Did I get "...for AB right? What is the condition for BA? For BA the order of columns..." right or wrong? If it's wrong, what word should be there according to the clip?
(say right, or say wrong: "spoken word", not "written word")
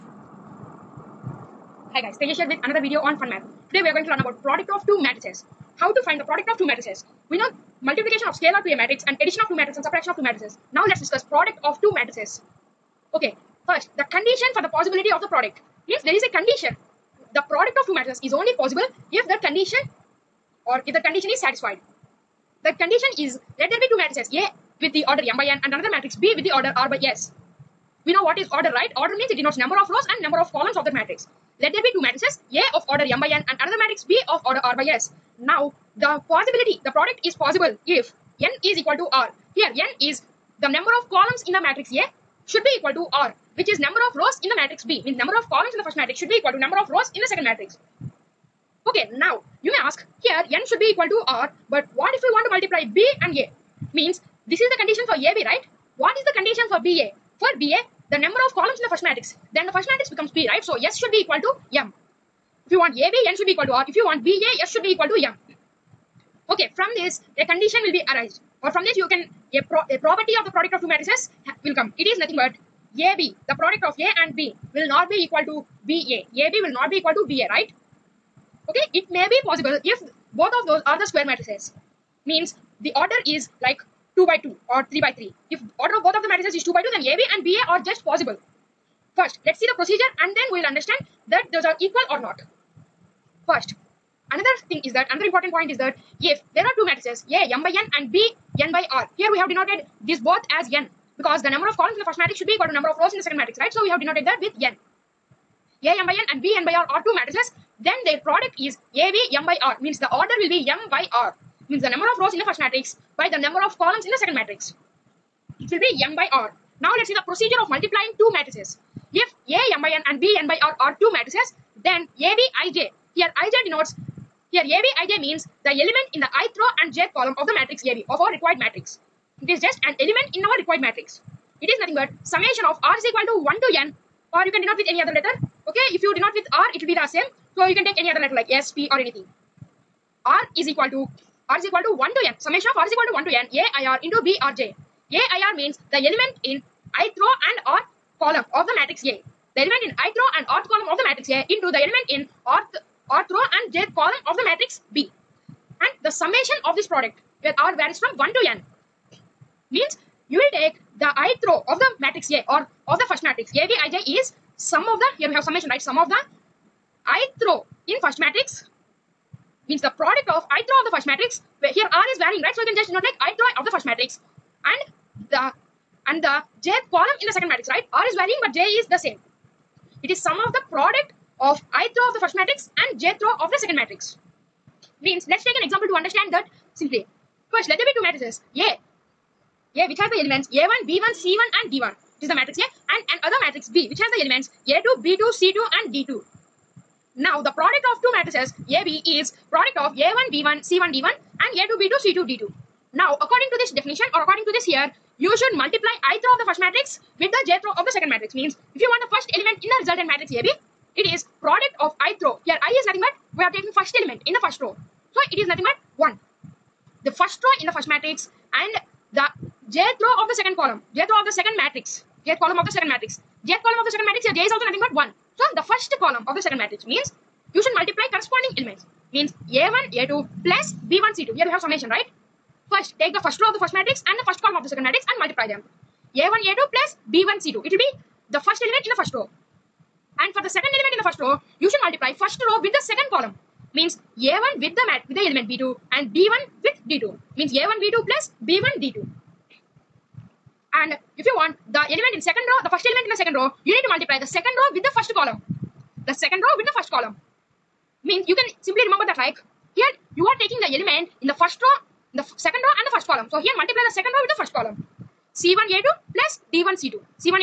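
wrong: "number", not "order".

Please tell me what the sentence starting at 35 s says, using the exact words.
Now the possibility, the product is possible if n is equal to r.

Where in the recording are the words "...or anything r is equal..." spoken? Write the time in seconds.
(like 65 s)
138 s.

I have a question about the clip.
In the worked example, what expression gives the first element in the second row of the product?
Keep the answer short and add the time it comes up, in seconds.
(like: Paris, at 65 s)
C1A2 + D1C2, at 265 s.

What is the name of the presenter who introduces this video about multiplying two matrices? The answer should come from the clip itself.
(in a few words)
Tejas.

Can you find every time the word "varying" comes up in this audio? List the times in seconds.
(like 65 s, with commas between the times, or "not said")
172 s, 178 s.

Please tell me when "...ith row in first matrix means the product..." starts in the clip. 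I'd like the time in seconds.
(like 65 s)
167 s.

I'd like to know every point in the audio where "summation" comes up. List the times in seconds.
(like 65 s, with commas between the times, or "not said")
132 s, 142 s, 156 s, 165 s, 231 s.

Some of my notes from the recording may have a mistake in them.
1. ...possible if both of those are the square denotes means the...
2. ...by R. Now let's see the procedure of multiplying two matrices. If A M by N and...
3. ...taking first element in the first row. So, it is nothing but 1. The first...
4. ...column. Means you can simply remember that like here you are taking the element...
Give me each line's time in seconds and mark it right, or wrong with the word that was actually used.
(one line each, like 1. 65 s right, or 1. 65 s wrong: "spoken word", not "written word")
1. 79 s wrong: "matrices", not "denotes"
2. 116 s right
3. 213 s right
4. 256 s right.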